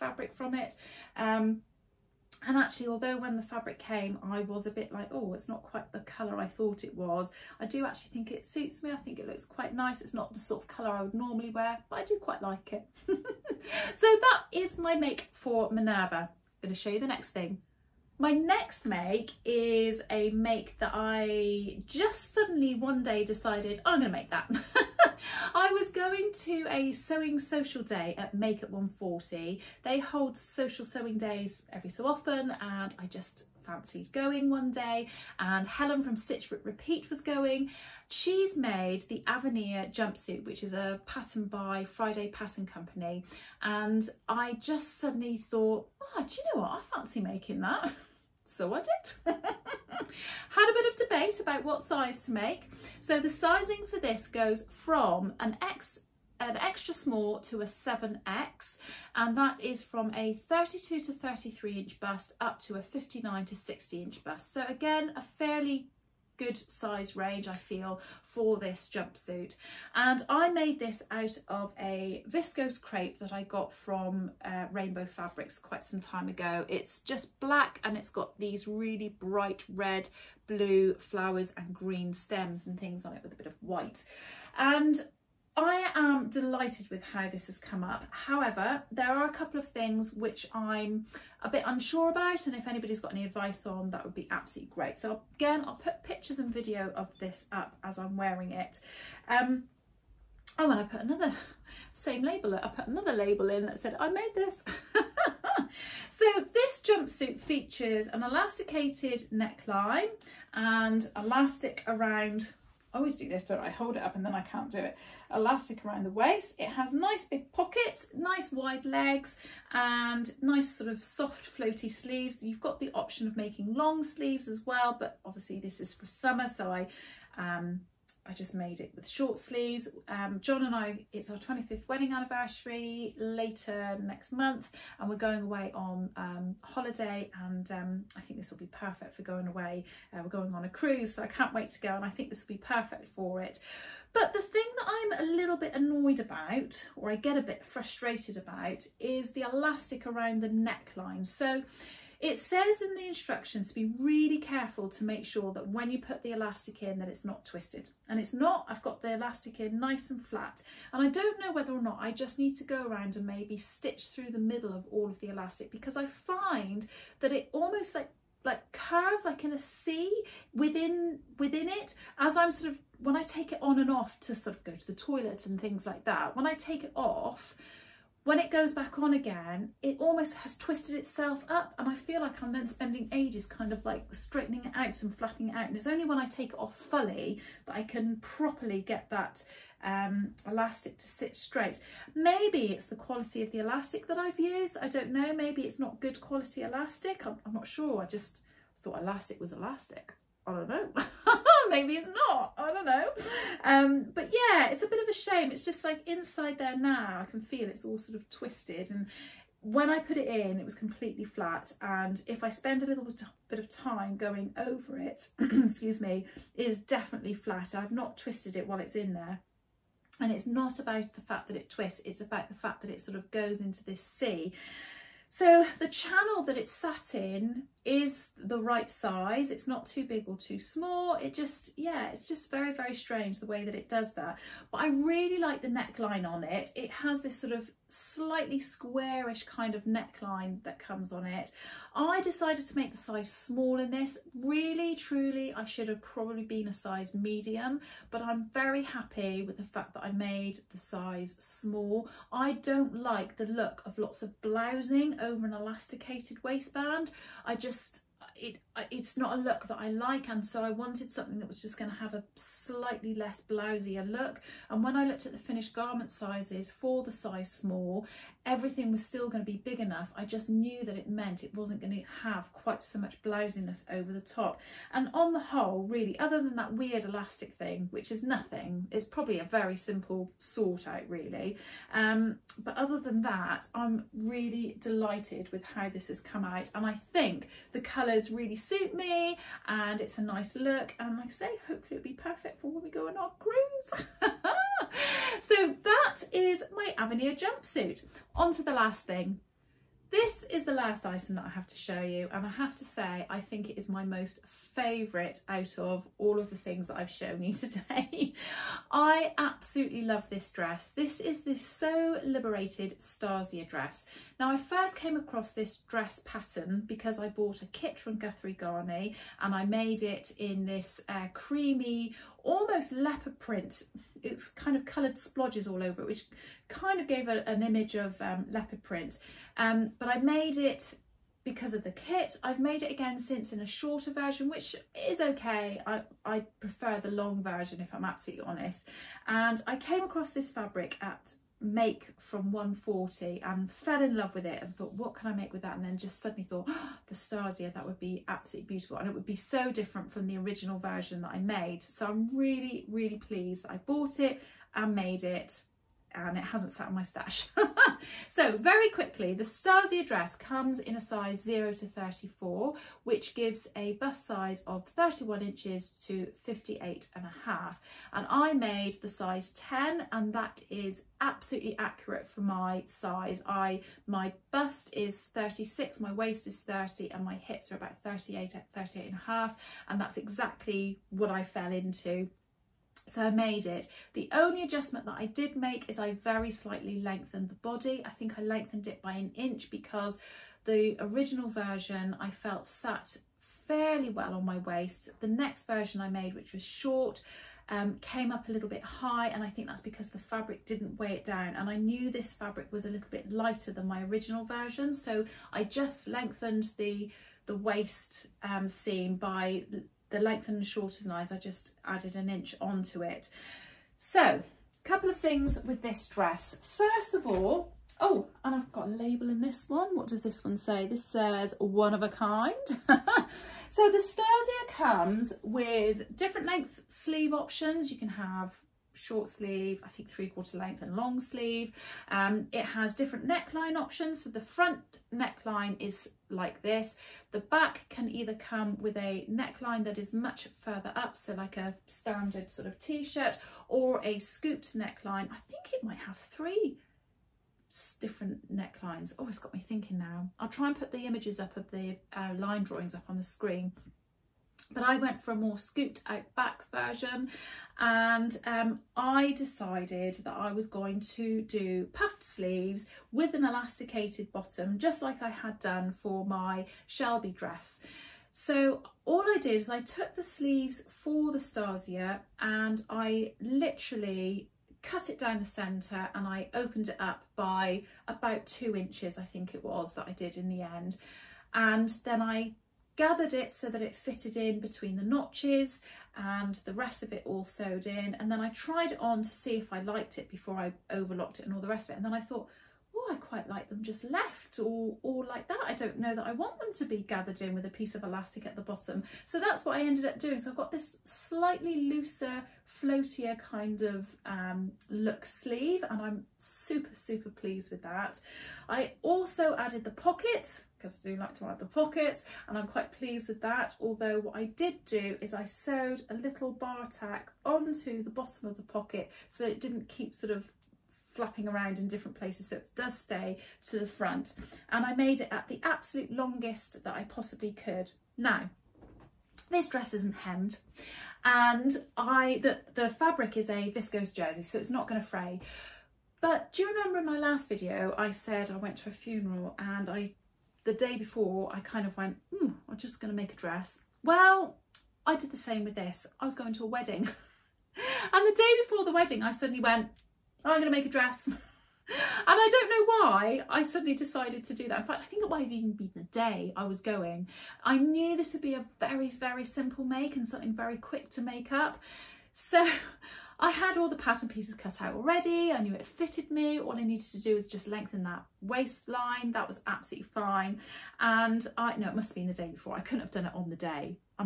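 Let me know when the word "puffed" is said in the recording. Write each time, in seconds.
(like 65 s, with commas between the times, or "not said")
461 s.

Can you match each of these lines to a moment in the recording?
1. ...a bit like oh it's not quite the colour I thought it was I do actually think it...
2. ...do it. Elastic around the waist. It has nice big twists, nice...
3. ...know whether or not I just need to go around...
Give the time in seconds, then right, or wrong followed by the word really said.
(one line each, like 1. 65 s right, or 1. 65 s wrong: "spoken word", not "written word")
1. 4 s right
2. 114 s wrong: "pockets", not "twists"
3. 161 s right.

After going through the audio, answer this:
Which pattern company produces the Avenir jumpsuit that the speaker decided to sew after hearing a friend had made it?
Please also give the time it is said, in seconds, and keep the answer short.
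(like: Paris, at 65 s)
Friday Pattern Company, at 41 s.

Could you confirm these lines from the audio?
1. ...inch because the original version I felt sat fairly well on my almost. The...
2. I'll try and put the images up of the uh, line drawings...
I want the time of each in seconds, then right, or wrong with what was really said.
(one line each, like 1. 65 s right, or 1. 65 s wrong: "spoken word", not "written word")
1. 389 s wrong: "waist", not "almost"
2. 450 s right.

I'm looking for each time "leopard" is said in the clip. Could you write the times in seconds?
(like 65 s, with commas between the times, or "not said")
322 s, 328 s.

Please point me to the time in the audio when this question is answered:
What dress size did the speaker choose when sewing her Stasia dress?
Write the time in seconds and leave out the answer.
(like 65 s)
369 s.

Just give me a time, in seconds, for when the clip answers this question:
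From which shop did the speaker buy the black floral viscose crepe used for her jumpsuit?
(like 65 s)
74 s.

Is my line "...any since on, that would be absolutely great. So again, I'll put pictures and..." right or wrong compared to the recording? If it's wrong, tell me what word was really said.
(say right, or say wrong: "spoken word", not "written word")
wrong: "advice", not "since".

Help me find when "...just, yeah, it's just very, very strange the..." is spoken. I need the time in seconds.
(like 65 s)
231 s.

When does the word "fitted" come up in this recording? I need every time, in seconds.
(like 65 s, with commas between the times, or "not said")
483 s, 565 s.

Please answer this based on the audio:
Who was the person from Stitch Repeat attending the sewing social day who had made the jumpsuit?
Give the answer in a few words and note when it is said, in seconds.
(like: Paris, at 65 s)
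Helen, at 35 s.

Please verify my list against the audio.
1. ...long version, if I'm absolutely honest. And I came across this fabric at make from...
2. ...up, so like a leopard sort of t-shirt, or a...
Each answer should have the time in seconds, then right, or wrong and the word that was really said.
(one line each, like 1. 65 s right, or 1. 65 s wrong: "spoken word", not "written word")
1. 337 s right
2. 440 s wrong: "standard", not "leopard".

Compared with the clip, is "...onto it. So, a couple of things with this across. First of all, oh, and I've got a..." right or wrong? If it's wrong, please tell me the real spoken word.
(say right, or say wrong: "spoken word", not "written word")
wrong: "dress", not "across".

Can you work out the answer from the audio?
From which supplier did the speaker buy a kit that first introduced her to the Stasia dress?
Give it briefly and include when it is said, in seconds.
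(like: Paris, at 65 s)
Guthrie Ghani, at 318 s.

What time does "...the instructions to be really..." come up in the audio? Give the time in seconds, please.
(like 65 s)
152 s.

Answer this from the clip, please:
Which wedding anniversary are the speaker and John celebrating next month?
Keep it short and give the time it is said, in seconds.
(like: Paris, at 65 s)
25th, at 131 s.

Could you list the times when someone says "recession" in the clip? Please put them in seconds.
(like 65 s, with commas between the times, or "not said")
not said.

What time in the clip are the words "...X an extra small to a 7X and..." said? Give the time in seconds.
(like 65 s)
55 s.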